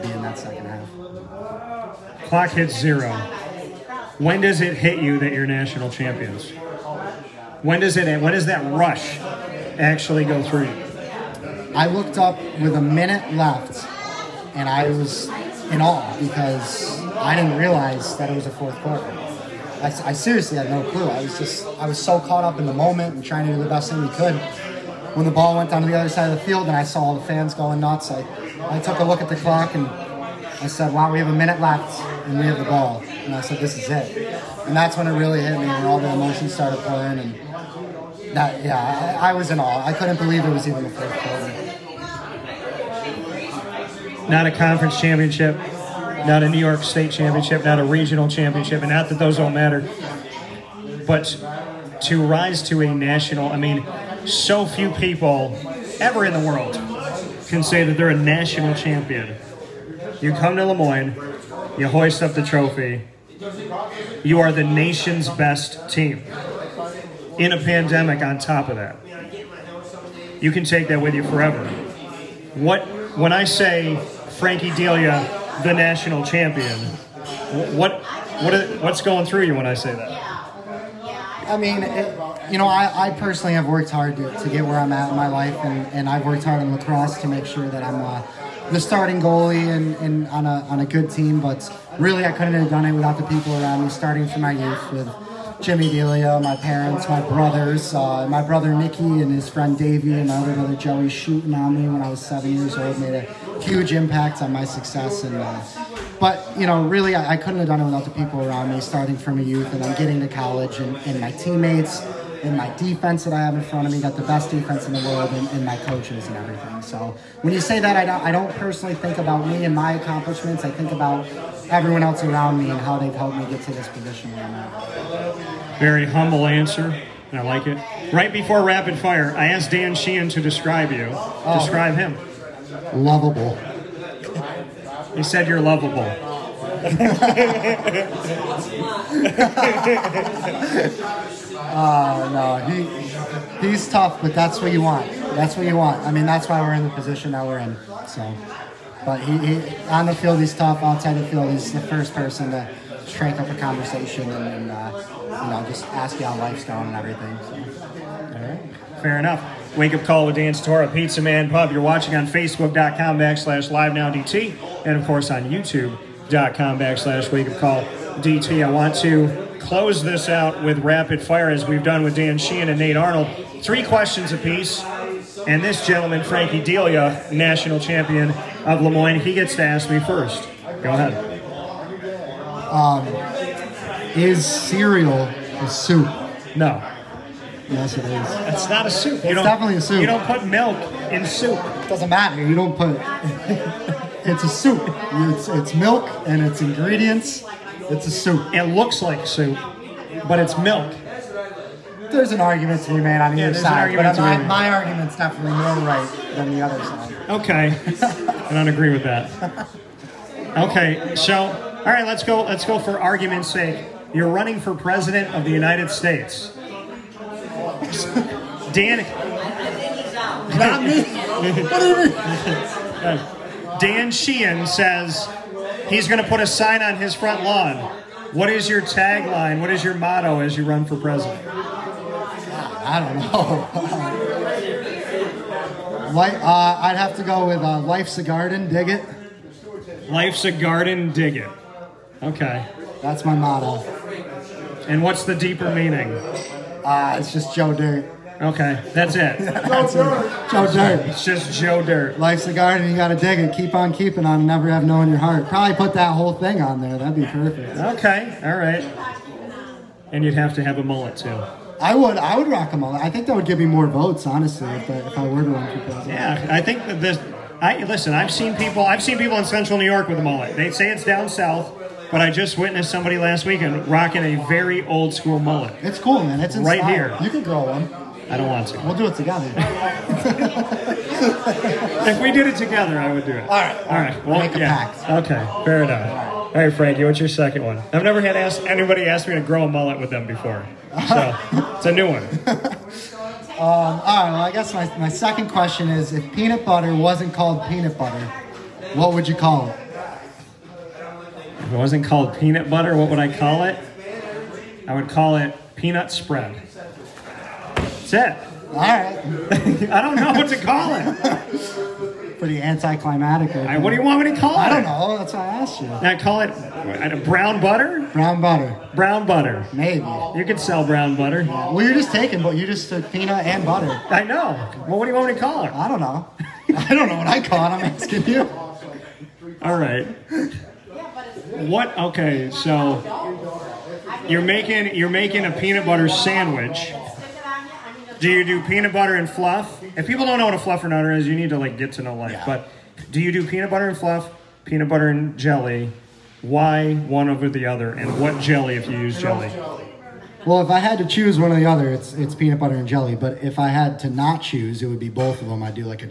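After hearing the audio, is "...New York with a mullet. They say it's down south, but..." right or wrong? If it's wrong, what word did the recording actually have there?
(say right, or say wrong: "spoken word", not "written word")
right.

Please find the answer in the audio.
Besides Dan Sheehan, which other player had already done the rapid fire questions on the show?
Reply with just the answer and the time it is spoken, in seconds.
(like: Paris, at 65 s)
Nate Arnold, at 172 s.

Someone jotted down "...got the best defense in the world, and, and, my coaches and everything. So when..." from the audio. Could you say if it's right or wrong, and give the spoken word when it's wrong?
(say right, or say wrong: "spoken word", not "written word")
right.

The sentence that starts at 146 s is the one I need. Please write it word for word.
I mean, that's why we're in the position that we're in.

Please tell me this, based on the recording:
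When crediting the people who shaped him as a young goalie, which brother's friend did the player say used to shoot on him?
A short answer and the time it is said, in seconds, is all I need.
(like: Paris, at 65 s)
Davey, at 99 s.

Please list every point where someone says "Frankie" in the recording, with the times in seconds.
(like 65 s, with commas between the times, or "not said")
74 s, 176 s, 286 s.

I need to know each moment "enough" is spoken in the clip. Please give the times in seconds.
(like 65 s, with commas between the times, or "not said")
159 s, 285 s.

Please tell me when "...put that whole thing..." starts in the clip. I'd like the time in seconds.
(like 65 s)
255 s.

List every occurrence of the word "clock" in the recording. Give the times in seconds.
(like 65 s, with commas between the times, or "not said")
2 s, 29 s.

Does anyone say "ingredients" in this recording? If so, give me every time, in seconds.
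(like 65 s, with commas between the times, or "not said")
196 s.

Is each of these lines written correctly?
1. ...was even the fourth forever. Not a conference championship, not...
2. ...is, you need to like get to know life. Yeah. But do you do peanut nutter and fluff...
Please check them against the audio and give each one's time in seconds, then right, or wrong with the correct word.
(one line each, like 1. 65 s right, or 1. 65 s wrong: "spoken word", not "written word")
1. 40 s wrong: "quarter", not "forever"
2. 341 s wrong: "butter", not "nutter".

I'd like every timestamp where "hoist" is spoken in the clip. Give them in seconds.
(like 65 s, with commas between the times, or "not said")
61 s.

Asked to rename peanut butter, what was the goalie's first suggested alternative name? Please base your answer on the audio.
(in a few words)
Peanut spread.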